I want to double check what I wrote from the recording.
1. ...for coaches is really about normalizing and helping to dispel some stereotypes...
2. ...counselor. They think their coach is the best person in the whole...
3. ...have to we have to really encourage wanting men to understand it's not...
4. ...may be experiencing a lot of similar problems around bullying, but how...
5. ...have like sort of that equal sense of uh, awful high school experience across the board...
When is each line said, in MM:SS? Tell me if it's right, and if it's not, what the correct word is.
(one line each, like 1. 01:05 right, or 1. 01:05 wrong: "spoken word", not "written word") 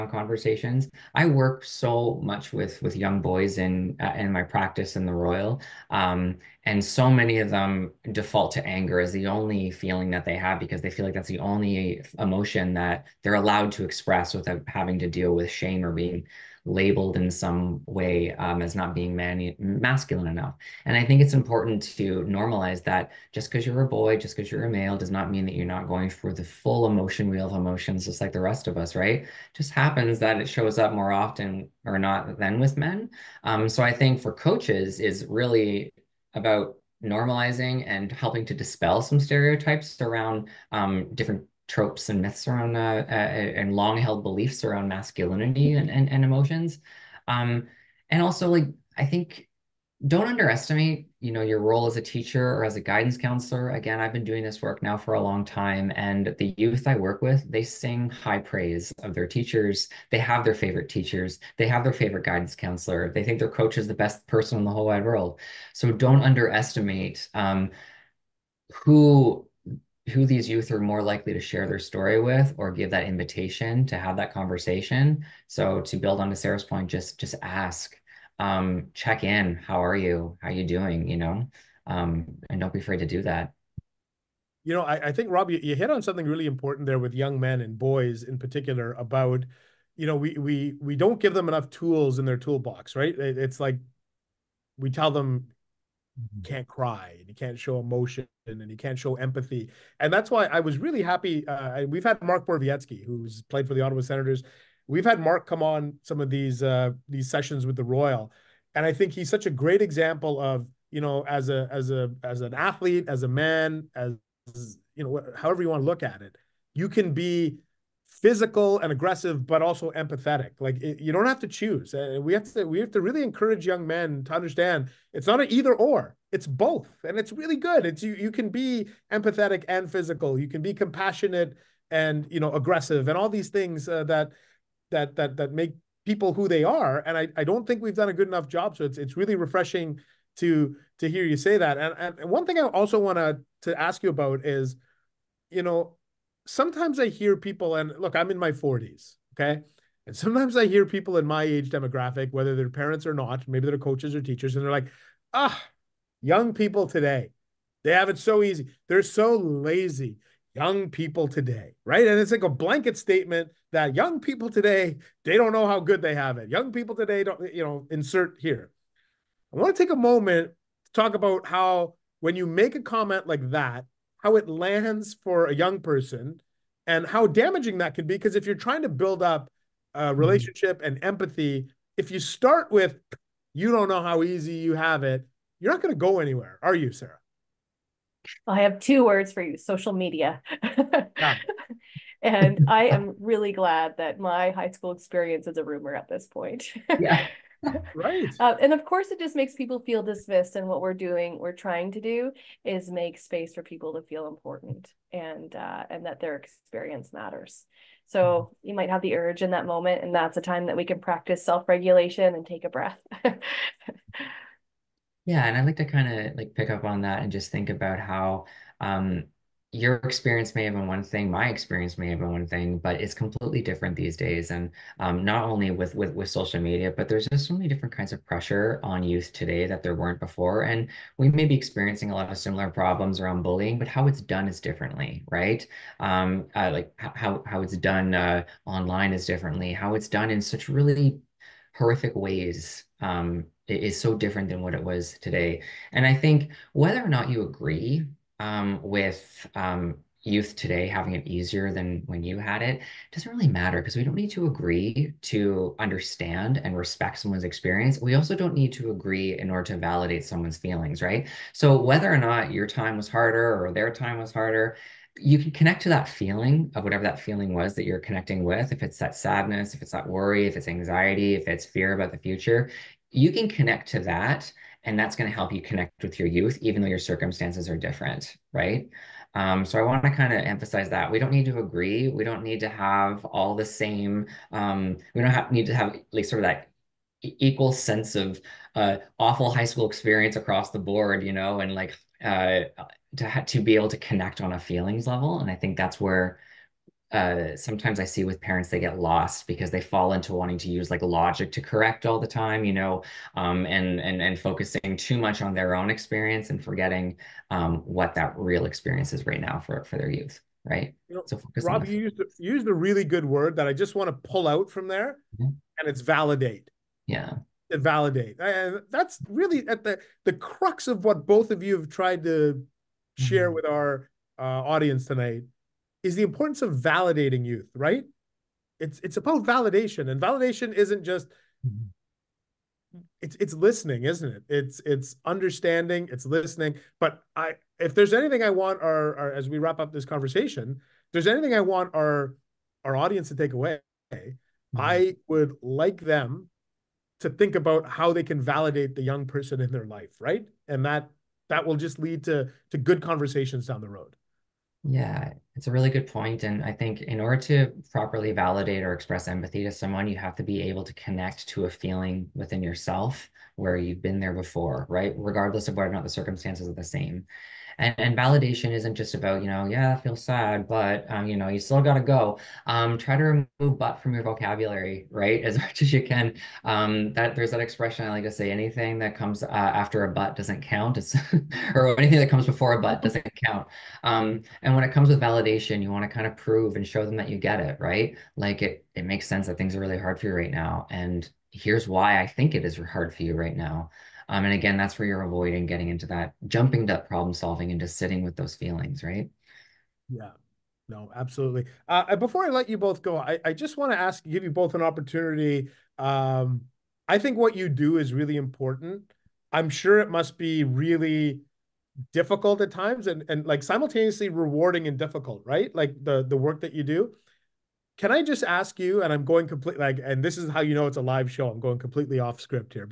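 1. 00:34 right
2. 01:02 right
3. 02:02 wrong: "young", not "wanting"
4. 03:51 right
5. 04:45 right.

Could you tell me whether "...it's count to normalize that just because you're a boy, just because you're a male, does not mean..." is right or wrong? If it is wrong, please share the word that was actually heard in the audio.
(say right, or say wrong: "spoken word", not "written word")
wrong: "important", not "count".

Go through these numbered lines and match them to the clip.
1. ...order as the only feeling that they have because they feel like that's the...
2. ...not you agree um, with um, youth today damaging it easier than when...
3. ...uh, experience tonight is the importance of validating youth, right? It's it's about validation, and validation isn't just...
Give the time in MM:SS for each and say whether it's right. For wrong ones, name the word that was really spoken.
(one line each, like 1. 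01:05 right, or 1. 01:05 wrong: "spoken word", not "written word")
1. 00:08 wrong: "anger", not "order"
2. 04:07 wrong: "having", not "damaging"
3. 05:24 wrong: "audience", not "experience".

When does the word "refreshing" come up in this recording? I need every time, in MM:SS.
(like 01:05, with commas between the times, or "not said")
02:19.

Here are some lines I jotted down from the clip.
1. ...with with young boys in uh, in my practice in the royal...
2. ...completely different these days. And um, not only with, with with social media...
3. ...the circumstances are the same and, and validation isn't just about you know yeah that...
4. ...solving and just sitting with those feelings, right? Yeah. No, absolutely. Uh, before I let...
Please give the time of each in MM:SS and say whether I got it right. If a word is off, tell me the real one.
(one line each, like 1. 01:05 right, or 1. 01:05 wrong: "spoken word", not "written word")
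1. 00:02 right
2. 03:43 right
3. 06:06 right
4. 06:37 right.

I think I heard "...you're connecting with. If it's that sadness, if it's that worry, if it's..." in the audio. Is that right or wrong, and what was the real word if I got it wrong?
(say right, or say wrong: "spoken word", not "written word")
right.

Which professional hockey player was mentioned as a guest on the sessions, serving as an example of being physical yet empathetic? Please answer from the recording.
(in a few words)
Mark Borowiecki.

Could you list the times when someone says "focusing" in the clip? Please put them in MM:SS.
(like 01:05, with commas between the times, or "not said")
05:04.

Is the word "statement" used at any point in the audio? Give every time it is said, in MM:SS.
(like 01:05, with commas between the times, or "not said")
02:42.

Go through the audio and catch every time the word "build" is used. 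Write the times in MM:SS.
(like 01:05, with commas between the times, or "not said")
01:15, 02:58.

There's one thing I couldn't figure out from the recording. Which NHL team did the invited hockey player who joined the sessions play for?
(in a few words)
Ottawa Senators.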